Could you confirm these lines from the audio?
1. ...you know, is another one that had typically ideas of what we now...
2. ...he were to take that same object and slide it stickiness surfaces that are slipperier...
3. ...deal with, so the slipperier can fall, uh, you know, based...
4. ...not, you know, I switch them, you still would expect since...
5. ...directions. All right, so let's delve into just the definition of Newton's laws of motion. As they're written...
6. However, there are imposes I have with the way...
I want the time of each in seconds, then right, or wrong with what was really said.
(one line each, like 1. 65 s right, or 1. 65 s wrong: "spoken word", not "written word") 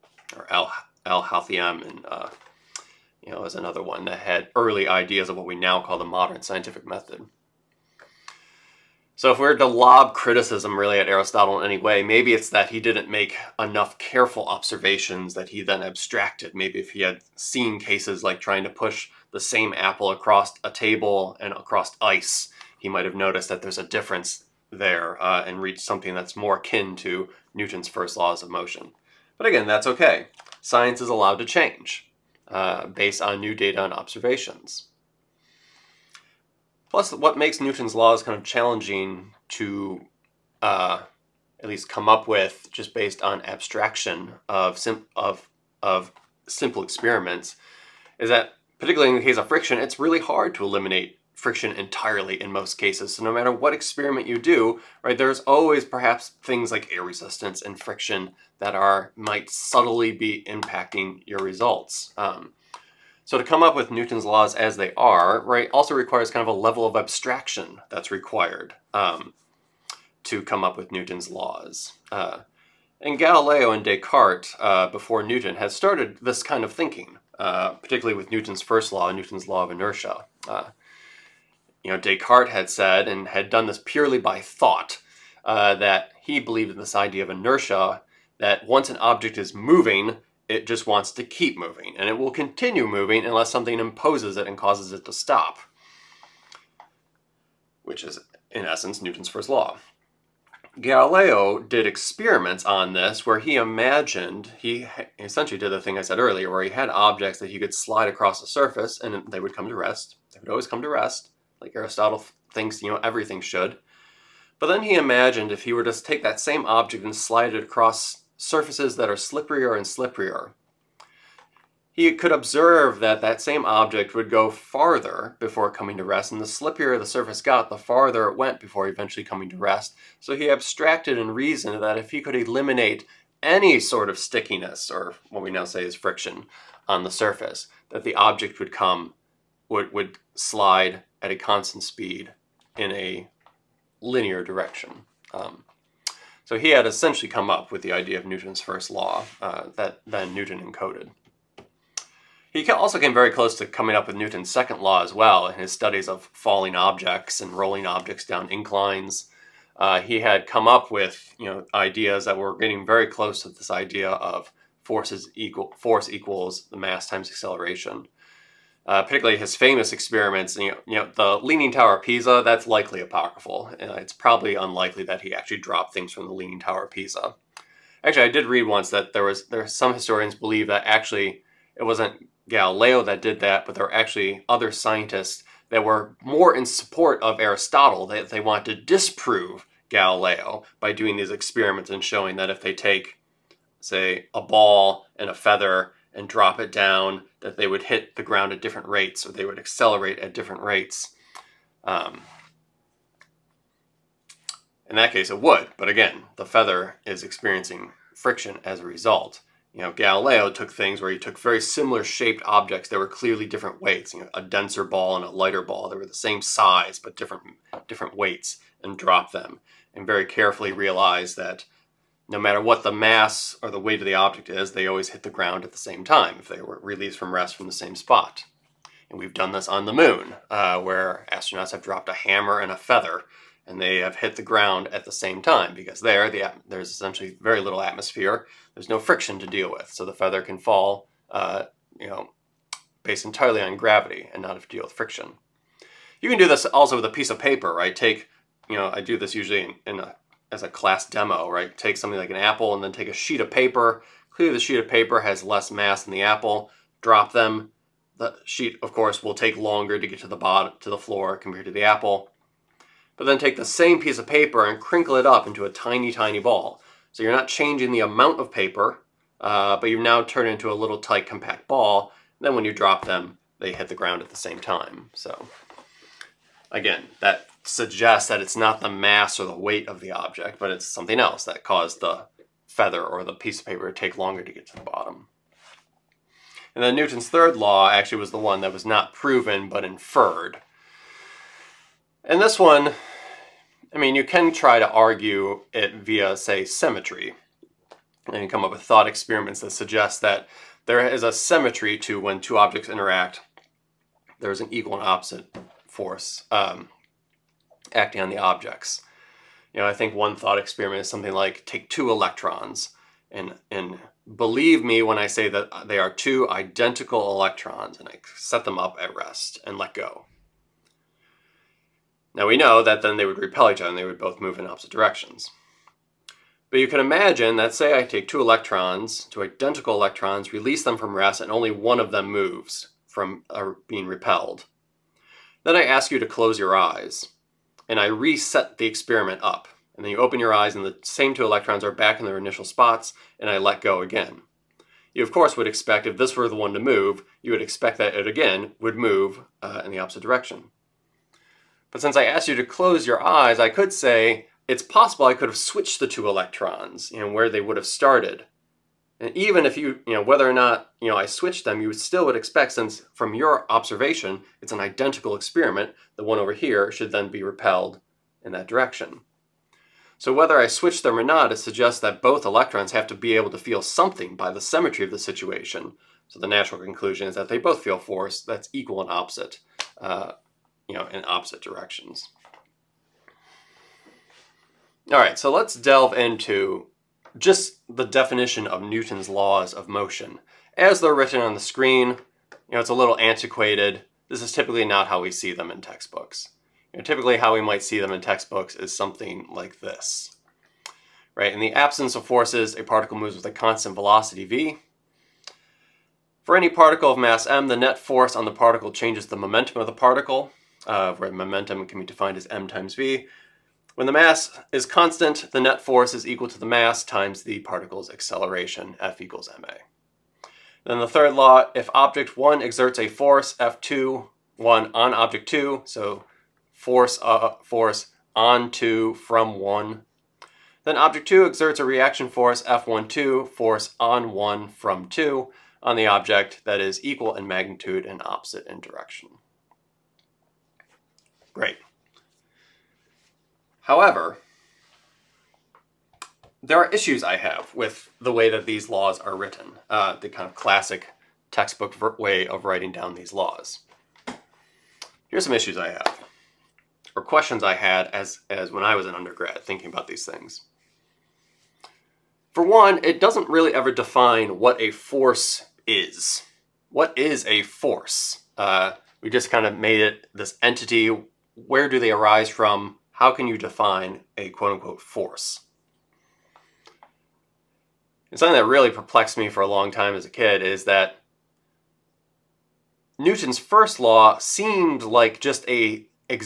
1. 3 s wrong: "early", not "typically"
2. 115 s wrong: "across", not "stickiness"
3. 239 s wrong: "feather", not "slipperier"
4. 360 s right
5. 381 s right
6. 443 s wrong: "issues", not "imposes".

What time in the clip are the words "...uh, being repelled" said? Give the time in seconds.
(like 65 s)
333 s.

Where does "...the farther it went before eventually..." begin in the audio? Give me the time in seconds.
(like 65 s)
127 s.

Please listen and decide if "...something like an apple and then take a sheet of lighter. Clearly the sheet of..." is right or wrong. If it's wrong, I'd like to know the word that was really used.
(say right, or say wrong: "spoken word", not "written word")
wrong: "paper", not "lighter".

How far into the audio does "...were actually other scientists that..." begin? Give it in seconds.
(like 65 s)
183 s.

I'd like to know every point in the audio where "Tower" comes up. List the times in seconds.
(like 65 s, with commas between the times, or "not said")
171 s, 176 s.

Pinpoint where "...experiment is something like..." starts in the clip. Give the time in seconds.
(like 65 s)
310 s.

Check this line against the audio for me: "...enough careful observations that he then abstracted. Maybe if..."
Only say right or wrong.
right.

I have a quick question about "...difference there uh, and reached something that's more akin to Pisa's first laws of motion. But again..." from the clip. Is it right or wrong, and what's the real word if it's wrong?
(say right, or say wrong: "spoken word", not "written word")
wrong: "Newton", not "Pisa".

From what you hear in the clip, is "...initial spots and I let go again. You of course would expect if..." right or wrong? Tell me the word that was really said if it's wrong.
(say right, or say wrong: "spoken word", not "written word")
right.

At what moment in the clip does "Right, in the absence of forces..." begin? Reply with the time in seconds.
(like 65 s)
401 s.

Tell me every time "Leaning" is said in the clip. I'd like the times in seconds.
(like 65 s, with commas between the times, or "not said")
171 s, 176 s.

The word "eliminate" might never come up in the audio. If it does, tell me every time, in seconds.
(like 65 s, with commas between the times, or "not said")
50 s, 132 s.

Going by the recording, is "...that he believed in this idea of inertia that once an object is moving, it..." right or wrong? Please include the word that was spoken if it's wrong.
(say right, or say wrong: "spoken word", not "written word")
right.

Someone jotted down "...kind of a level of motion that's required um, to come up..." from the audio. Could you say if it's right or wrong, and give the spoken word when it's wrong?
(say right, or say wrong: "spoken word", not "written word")
wrong: "abstraction", not "motion".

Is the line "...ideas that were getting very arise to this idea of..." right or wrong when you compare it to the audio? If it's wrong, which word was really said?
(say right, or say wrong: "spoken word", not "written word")
wrong: "close", not "arise".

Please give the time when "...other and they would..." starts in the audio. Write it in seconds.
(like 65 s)
323 s.